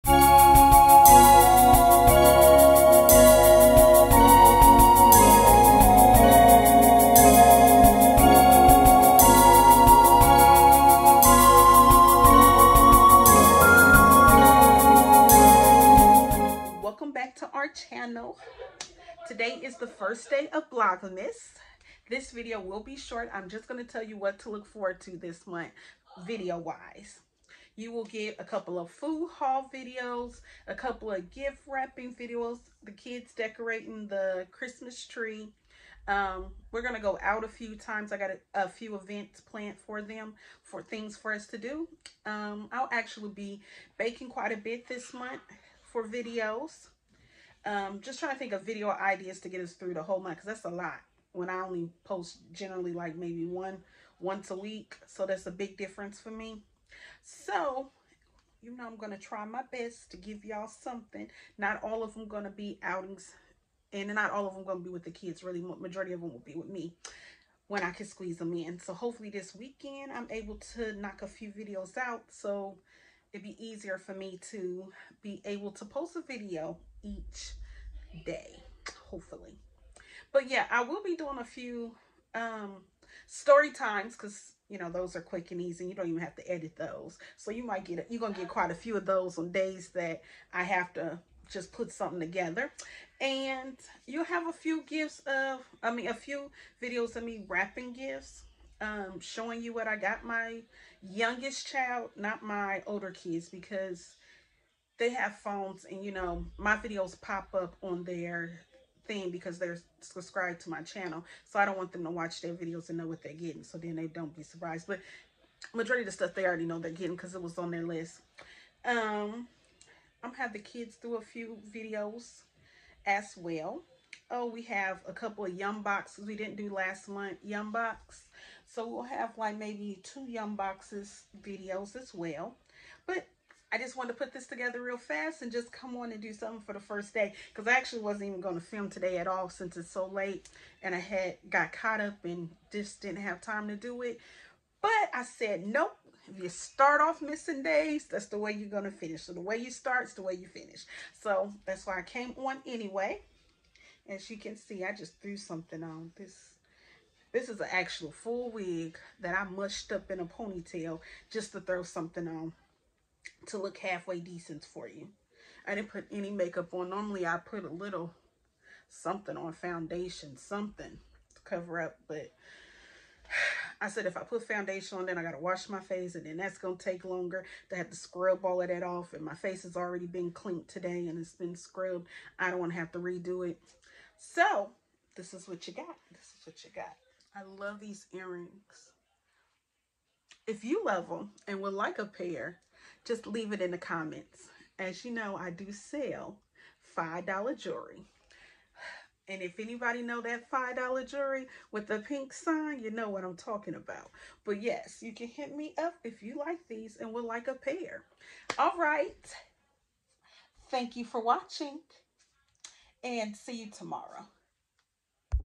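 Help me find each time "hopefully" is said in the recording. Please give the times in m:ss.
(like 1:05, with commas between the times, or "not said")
1:08, 1:19.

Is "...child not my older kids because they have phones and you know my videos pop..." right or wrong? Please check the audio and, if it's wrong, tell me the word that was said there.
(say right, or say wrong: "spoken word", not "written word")
right.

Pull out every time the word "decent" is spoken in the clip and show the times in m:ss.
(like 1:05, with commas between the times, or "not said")
2:44.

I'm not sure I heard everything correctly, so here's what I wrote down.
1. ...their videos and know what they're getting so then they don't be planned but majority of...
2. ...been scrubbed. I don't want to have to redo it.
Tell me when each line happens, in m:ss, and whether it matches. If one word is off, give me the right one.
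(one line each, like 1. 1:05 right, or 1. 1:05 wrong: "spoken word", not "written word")
1. 1:52 wrong: "surprised", not "planned"
2. 3:01 right.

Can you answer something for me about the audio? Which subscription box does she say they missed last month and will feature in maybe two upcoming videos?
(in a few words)
Yum box.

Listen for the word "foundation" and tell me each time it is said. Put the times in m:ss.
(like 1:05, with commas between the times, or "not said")
2:49, 2:54.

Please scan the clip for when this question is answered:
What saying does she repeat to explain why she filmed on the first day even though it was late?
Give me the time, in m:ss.
2:29.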